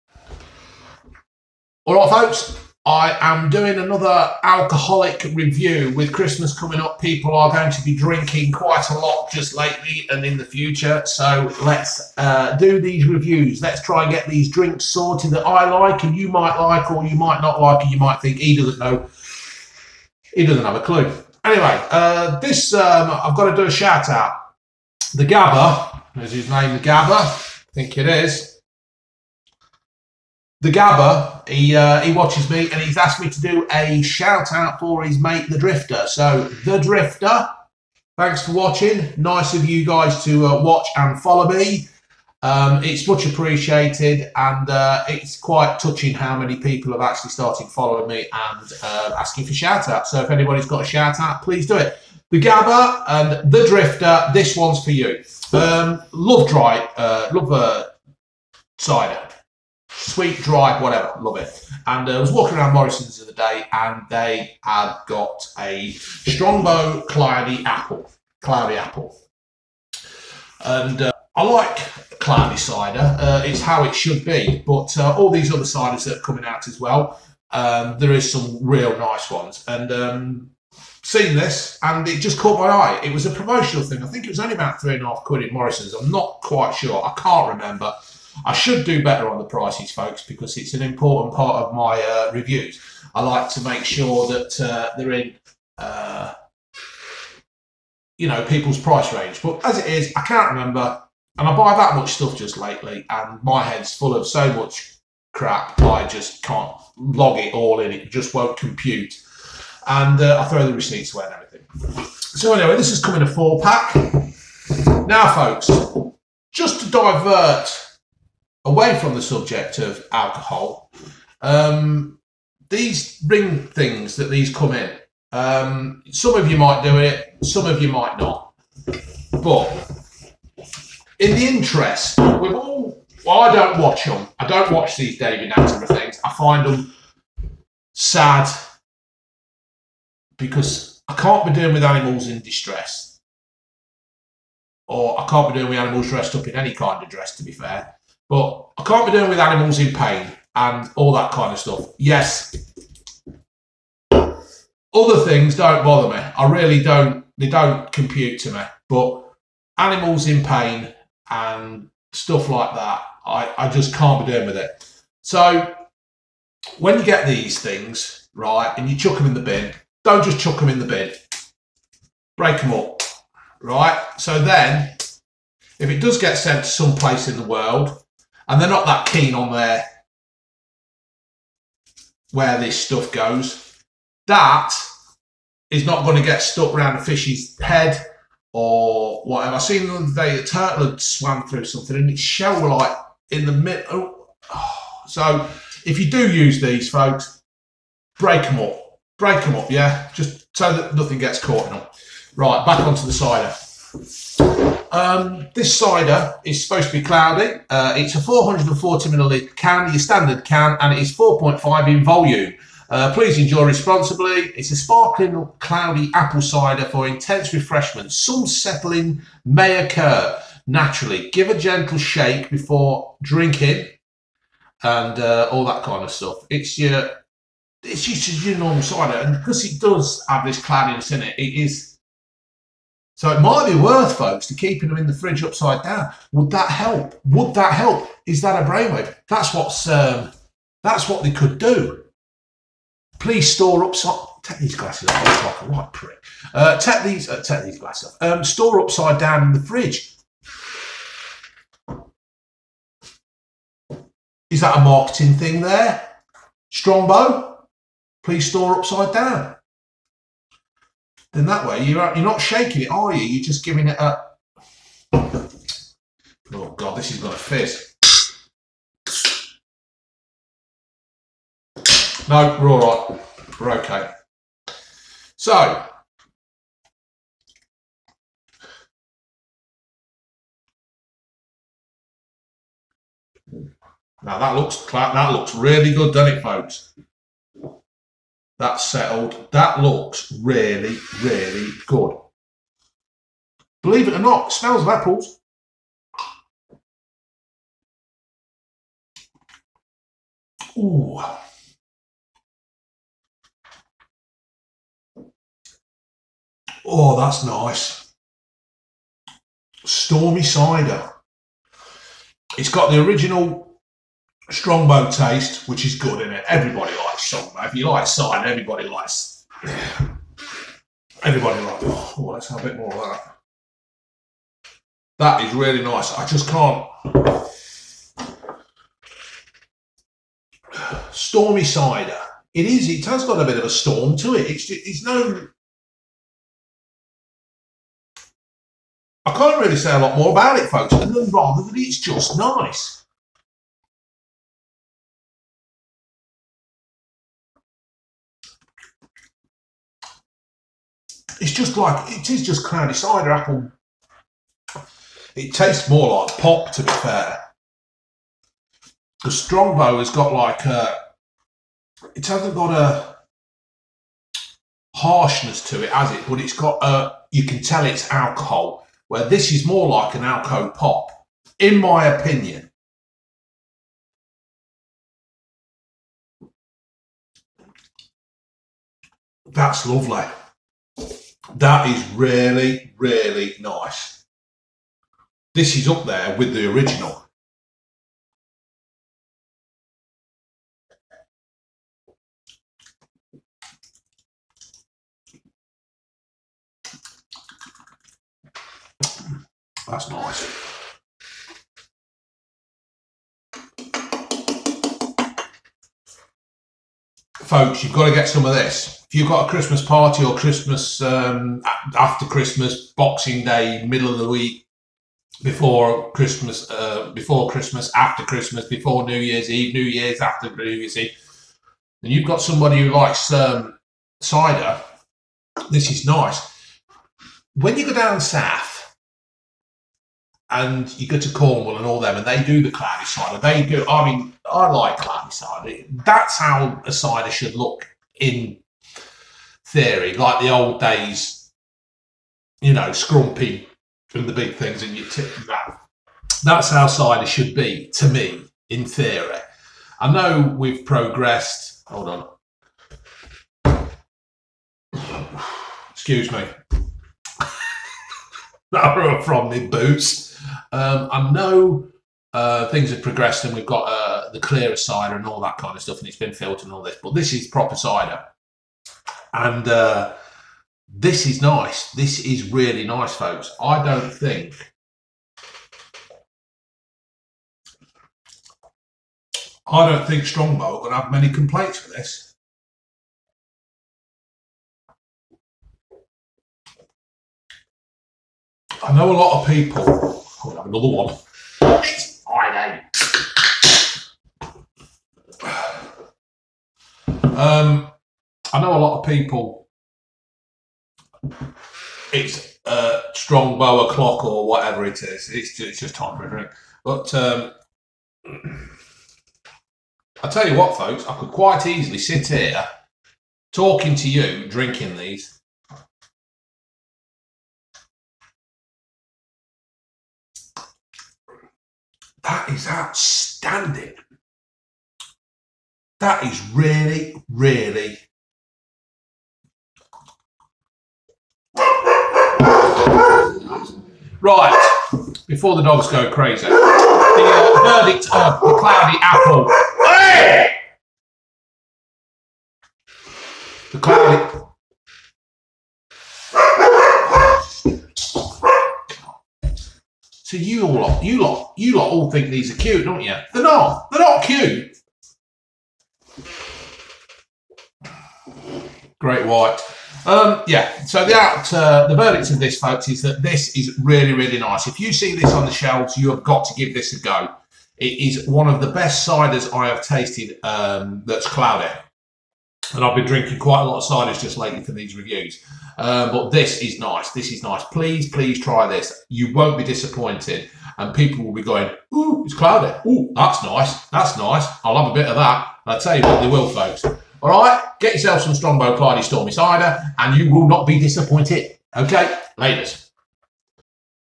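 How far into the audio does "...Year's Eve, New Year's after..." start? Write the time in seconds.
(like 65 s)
419 s.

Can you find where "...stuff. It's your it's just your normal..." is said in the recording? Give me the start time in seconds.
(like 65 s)
226 s.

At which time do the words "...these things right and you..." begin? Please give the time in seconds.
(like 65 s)
167 s.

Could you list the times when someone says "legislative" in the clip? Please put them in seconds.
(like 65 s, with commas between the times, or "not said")
not said.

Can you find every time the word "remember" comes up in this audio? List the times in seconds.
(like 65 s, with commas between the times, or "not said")
87 s, 100 s.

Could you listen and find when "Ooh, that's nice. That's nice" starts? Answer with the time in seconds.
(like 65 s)
582 s.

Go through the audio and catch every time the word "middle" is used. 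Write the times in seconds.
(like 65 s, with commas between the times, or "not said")
193 s, 413 s.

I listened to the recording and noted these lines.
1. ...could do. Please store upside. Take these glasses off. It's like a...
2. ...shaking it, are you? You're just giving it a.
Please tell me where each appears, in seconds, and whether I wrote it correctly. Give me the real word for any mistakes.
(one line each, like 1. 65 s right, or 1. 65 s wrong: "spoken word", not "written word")
1. 241 s right
2. 262 s right.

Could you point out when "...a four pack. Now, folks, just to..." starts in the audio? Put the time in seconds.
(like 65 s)
113 s.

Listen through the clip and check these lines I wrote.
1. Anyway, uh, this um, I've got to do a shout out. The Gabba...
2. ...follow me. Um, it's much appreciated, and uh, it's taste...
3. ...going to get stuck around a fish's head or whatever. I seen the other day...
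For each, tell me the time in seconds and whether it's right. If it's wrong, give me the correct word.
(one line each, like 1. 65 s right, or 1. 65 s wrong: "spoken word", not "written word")
1. 21 s right
2. 41 s wrong: "quite", not "taste"
3. 186 s right.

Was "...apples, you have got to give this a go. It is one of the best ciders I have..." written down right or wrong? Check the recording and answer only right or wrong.
wrong.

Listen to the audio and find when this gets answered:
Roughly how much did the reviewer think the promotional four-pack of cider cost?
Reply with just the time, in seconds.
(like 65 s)
84 s.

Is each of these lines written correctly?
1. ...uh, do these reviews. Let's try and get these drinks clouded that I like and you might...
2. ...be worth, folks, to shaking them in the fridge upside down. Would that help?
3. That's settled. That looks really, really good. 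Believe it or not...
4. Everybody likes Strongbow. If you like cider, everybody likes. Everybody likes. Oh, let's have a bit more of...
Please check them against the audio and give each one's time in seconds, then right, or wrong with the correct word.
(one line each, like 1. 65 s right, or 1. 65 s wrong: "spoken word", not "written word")
1. 12 s wrong: "sorted", not "clouded"
2. 233 s wrong: "keeping", not "shaking"
3. 288 s right
4. 316 s right.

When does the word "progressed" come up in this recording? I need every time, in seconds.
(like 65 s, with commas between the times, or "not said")
450 s, 463 s.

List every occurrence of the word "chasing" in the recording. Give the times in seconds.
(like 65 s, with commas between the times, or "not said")
not said.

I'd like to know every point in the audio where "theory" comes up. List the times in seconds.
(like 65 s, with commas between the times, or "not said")
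439 s, 448 s.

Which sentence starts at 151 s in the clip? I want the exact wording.
Yes, other things don't bother me.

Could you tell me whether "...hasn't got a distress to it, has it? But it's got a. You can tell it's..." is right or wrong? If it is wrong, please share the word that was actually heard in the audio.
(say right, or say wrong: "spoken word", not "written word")
wrong: "harshness", not "distress".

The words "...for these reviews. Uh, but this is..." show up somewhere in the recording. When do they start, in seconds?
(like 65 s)
574 s.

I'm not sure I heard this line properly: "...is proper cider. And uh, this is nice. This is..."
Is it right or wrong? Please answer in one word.
right.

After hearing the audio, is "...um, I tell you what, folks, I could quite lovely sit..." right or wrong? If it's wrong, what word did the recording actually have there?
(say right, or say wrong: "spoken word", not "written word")
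wrong: "easily", not "lovely".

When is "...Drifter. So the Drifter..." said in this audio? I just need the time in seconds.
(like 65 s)
35 s.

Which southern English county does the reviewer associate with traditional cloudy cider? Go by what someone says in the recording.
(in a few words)
Cornwall.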